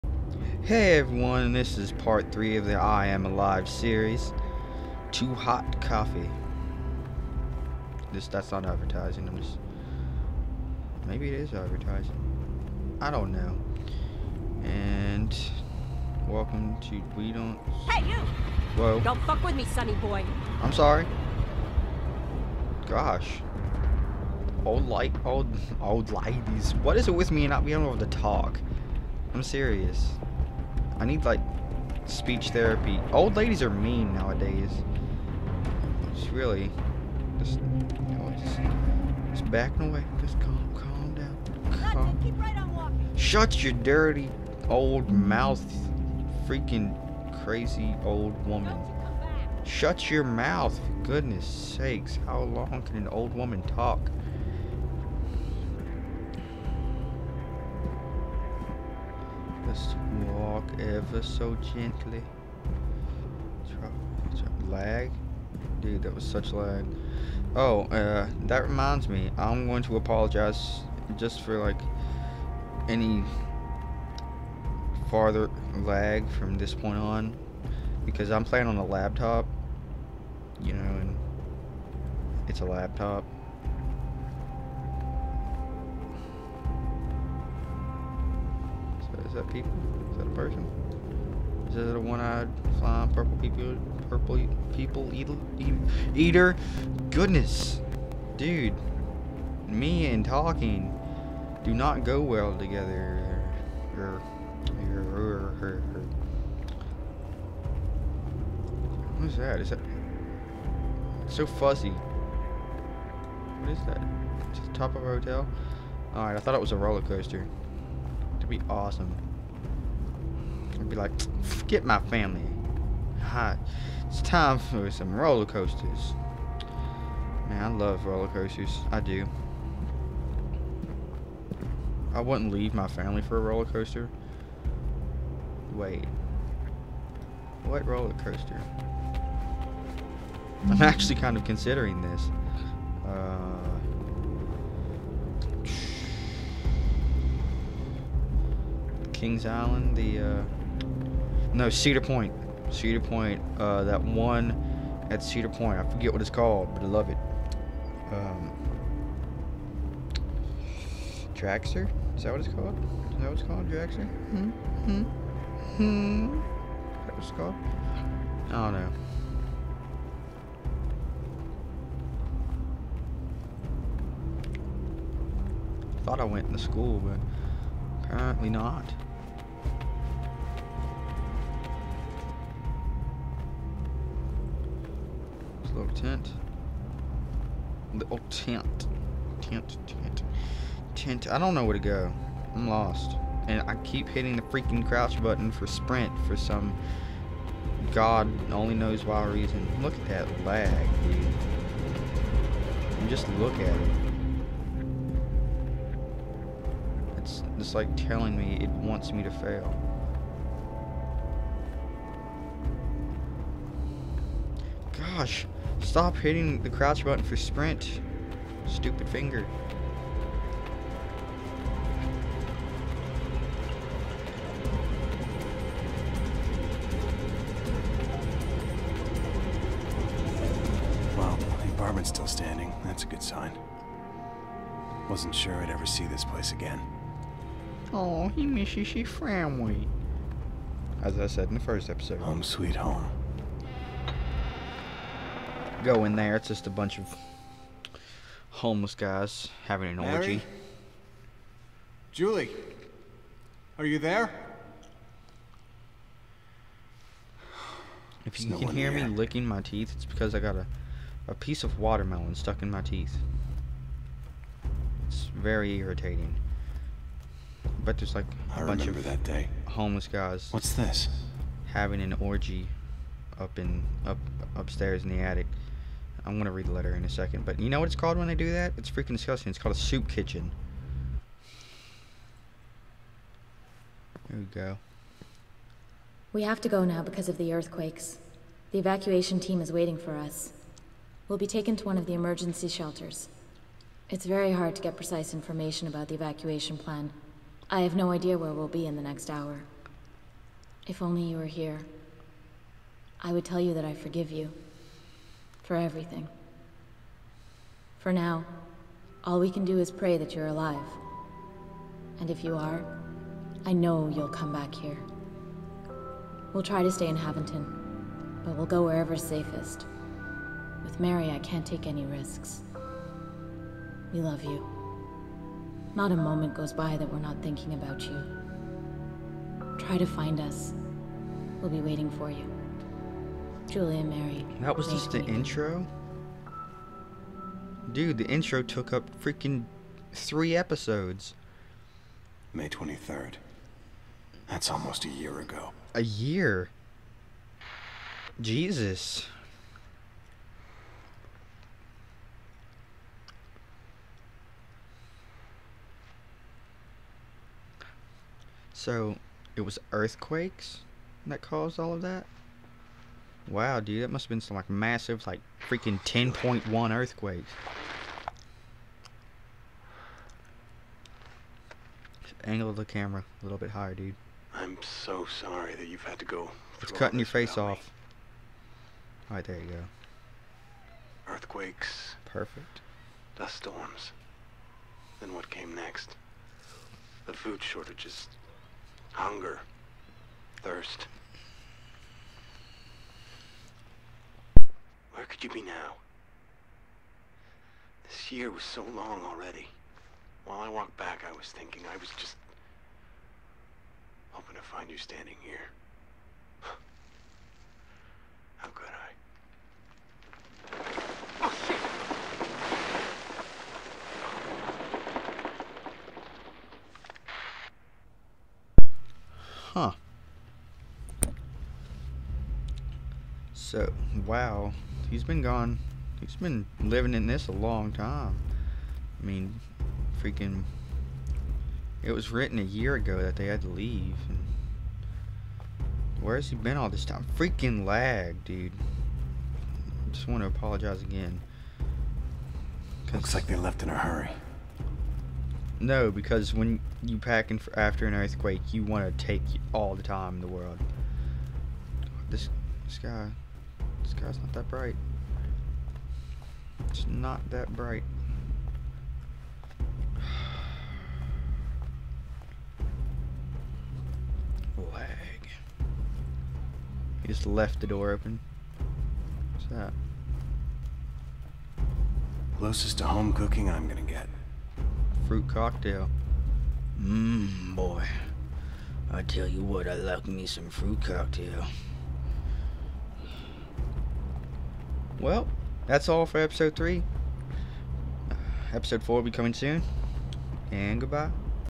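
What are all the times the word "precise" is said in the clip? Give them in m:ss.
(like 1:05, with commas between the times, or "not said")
4:54.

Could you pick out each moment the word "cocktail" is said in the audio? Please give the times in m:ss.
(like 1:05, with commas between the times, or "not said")
7:55, 8:01.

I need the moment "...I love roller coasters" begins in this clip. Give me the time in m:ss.
2:07.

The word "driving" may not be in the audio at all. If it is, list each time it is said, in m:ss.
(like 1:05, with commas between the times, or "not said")
not said.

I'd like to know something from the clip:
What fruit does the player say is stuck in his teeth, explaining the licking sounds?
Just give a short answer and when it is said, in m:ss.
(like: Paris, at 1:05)
watermelon, at 4:21.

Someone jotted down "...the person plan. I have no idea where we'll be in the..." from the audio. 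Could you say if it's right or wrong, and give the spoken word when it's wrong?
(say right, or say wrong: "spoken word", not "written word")
wrong: "evacuation", not "person".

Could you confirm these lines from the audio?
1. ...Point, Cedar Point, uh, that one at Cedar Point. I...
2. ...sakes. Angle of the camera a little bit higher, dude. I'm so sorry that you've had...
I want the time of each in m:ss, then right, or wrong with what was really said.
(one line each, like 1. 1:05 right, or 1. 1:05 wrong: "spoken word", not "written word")
1. 2:32 right
2. 6:06 wrong: "earthquakes", not "sakes".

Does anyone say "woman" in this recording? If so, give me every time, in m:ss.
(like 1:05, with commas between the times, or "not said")
0:48, 0:53.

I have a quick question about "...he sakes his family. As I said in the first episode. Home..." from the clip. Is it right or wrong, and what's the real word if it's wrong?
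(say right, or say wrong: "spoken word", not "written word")
wrong: "misses", not "sakes".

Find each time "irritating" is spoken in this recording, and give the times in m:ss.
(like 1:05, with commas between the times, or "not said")
4:25.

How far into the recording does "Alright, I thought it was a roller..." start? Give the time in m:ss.
1:56.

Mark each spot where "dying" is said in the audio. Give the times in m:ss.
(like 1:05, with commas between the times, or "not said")
not said.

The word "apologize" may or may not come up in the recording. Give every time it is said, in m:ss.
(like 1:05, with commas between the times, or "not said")
1:09, 7:20.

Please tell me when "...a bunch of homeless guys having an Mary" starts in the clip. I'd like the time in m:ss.
4:06.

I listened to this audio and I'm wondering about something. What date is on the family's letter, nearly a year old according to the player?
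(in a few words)
May 23rd.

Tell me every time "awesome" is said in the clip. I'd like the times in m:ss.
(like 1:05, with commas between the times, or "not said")
1:58.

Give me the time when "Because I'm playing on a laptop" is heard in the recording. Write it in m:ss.
1:18.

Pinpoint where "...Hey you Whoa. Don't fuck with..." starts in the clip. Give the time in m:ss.
0:17.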